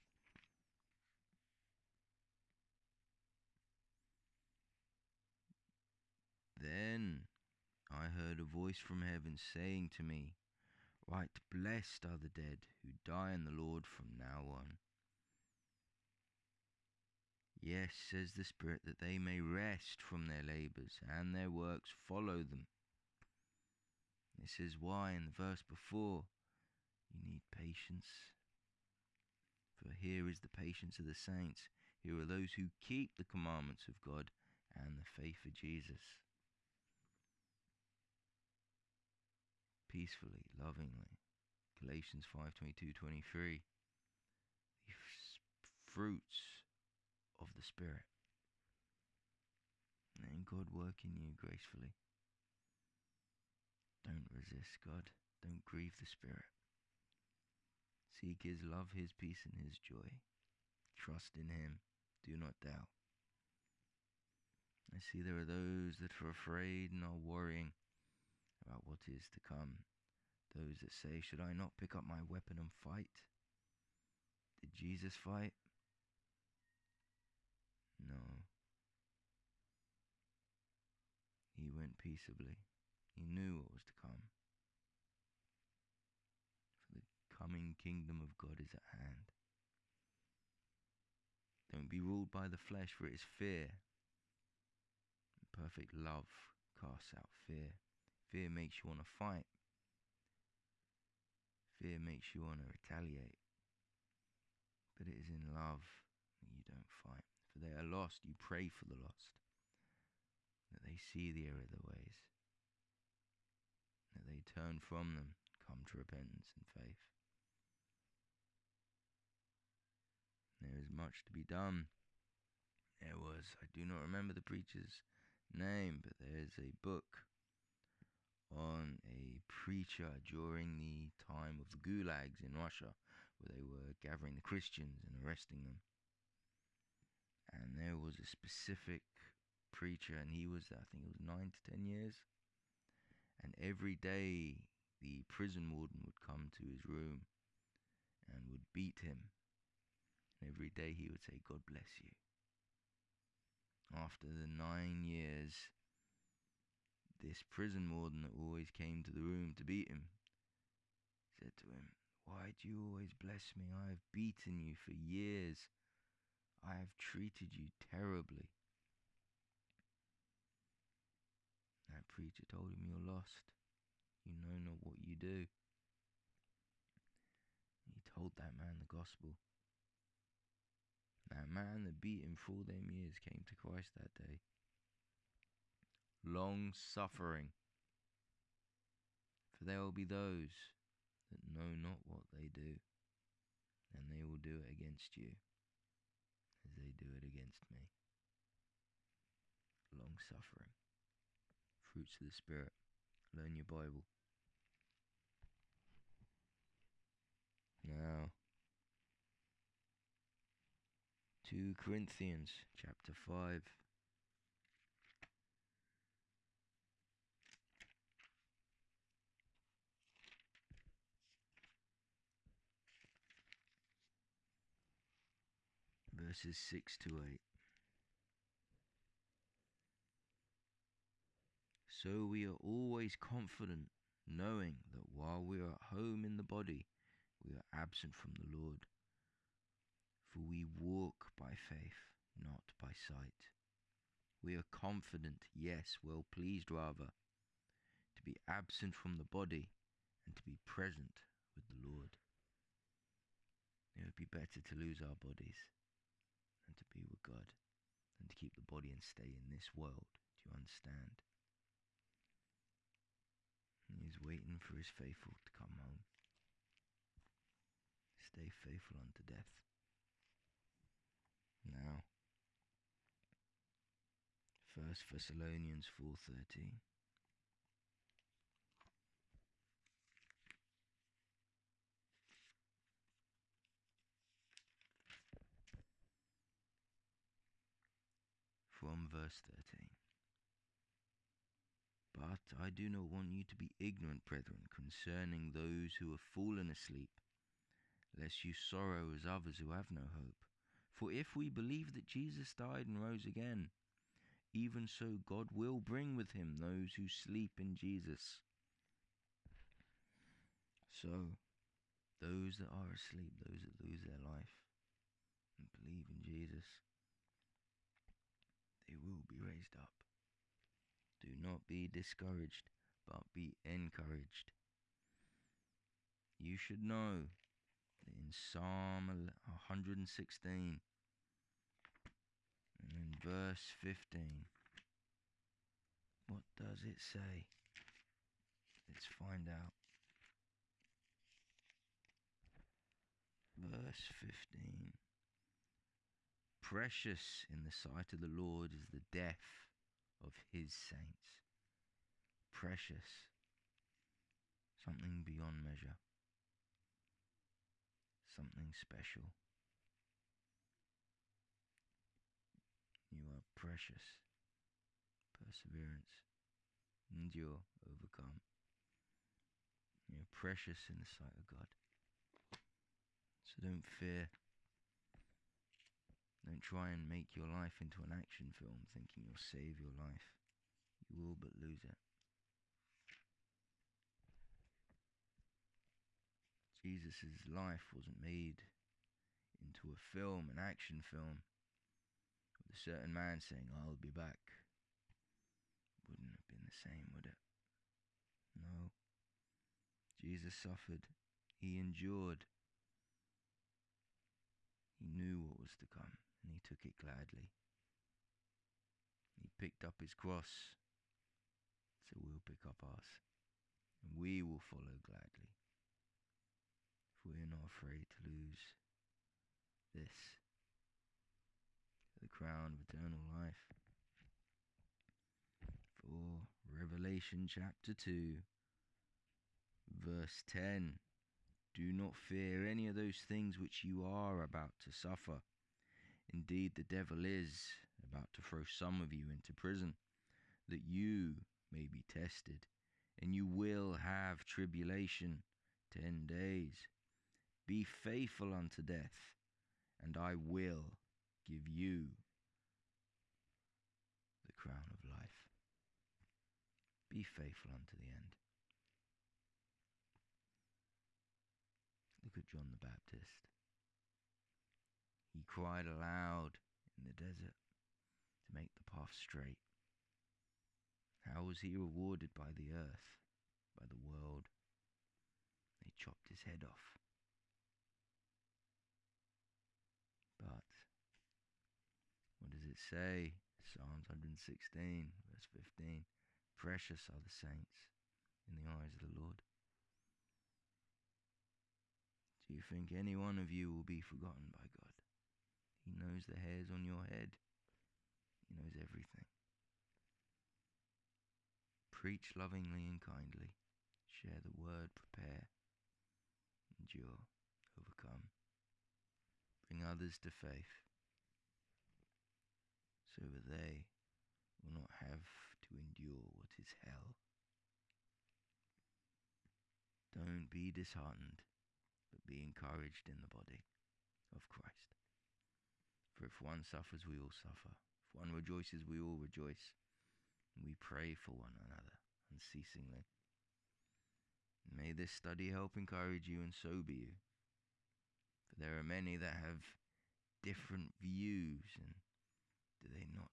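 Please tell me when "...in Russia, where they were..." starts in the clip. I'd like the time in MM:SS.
02:12.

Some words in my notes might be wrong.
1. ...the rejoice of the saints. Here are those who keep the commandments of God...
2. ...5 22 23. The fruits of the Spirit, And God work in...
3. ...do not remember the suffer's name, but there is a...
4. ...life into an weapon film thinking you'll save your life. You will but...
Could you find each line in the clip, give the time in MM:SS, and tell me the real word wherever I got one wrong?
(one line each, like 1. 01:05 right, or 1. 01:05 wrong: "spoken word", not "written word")
1. 00:30 wrong: "patience", not "rejoice"
2. 00:42 right
3. 02:03 wrong: "preacher", not "suffer"
4. 06:17 wrong: "action", not "weapon".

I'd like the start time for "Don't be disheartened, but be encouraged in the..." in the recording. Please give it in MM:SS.
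08:40.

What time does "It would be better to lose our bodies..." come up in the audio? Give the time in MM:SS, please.
04:13.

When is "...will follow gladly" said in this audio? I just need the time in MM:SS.
06:54.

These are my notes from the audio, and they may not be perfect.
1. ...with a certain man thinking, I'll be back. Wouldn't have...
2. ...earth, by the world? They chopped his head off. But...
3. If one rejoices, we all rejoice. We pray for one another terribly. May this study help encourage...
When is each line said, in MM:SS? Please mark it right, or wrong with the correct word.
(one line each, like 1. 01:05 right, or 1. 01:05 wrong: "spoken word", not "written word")
1. 06:32 wrong: "saying", not "thinking"
2. 07:52 right
3. 08:48 wrong: "unceasingly", not "terribly".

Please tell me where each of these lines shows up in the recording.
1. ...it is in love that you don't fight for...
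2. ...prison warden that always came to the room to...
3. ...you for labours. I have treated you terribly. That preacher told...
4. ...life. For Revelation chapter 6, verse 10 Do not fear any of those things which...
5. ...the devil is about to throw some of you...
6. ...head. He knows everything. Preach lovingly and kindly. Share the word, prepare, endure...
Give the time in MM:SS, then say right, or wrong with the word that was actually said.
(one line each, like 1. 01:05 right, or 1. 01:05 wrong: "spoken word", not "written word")
1. 01:45 right
2. 02:37 right
3. 02:44 wrong: "years", not "labours"
4. 07:03 wrong: "2", not "6"
5. 07:16 right
6. 08:17 right.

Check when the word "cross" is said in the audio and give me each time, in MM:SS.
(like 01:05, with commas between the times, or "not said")
06:50.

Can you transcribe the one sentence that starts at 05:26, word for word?
You should know that in Psalm 116 and in verse 15, what does it say?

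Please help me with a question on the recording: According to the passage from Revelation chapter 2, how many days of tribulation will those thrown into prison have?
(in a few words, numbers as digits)
10.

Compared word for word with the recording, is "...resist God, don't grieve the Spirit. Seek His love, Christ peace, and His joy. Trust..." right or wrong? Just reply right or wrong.
wrong.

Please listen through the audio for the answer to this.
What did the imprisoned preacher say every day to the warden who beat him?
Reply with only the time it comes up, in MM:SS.
02:31.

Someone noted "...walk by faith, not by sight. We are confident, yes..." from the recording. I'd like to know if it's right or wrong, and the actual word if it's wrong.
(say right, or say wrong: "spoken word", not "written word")
right.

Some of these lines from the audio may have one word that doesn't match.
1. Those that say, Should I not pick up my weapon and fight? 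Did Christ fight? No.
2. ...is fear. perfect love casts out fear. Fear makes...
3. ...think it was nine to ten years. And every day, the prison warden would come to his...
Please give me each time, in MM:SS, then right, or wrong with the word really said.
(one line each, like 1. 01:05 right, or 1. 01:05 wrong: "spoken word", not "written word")
1. 01:10 wrong: "Jesus", not "Christ"
2. 01:33 right
3. 02:20 right.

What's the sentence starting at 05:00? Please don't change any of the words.
For if we believe that Jesus died and rose again, even so God will bring with him those who sleep in Jesus.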